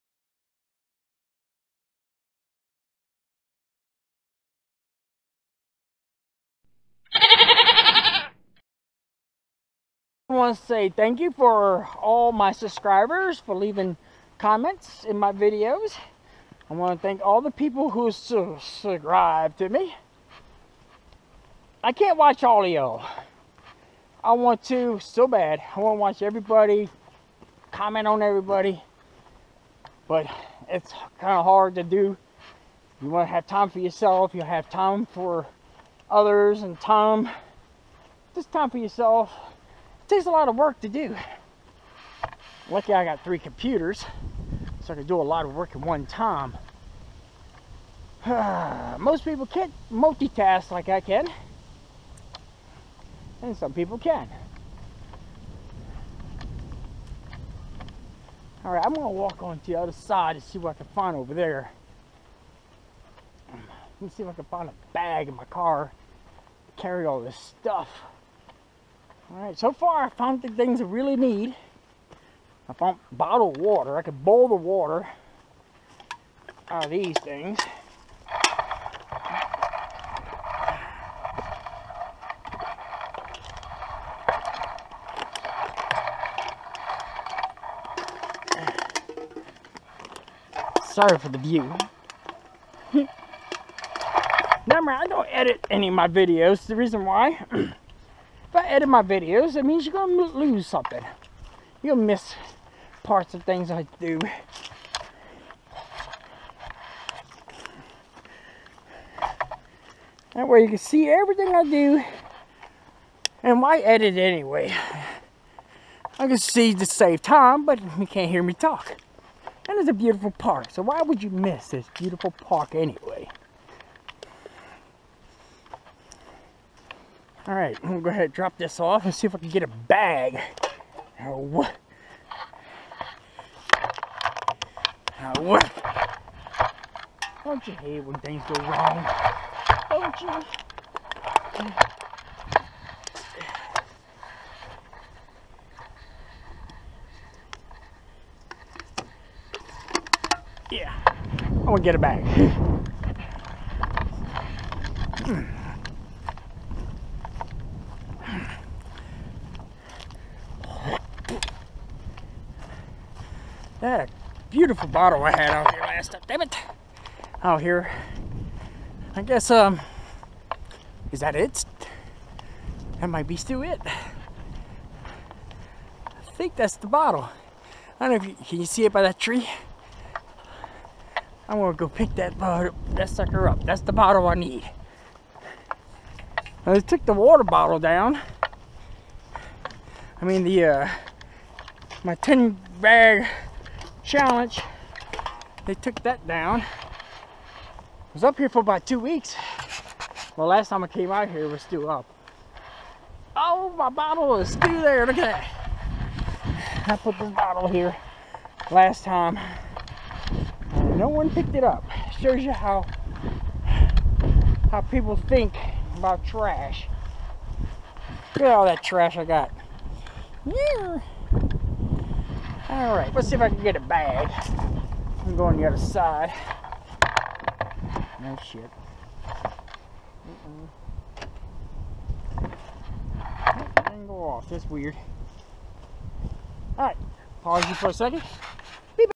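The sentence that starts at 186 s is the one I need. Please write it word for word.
I took the water bottle down.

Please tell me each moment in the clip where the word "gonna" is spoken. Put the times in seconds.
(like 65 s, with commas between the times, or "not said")
58 s, 99 s, 127 s, 151 s, 181 s.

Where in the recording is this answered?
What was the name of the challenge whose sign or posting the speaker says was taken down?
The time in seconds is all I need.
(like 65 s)
192 s.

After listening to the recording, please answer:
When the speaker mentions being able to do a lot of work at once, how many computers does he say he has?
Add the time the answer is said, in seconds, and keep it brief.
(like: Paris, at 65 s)
3, at 43 s.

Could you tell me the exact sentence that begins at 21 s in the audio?
I can't watch all of y'all.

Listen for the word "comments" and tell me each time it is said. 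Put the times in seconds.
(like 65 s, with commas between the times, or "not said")
14 s, 27 s.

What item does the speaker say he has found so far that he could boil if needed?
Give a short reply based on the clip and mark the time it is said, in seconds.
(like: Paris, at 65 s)
bottled water, at 73 s.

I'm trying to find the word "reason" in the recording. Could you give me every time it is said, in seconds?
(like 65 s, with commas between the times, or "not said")
96 s.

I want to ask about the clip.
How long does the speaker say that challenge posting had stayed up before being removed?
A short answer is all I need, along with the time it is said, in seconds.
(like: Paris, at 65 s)
about two weeks, at 198 s.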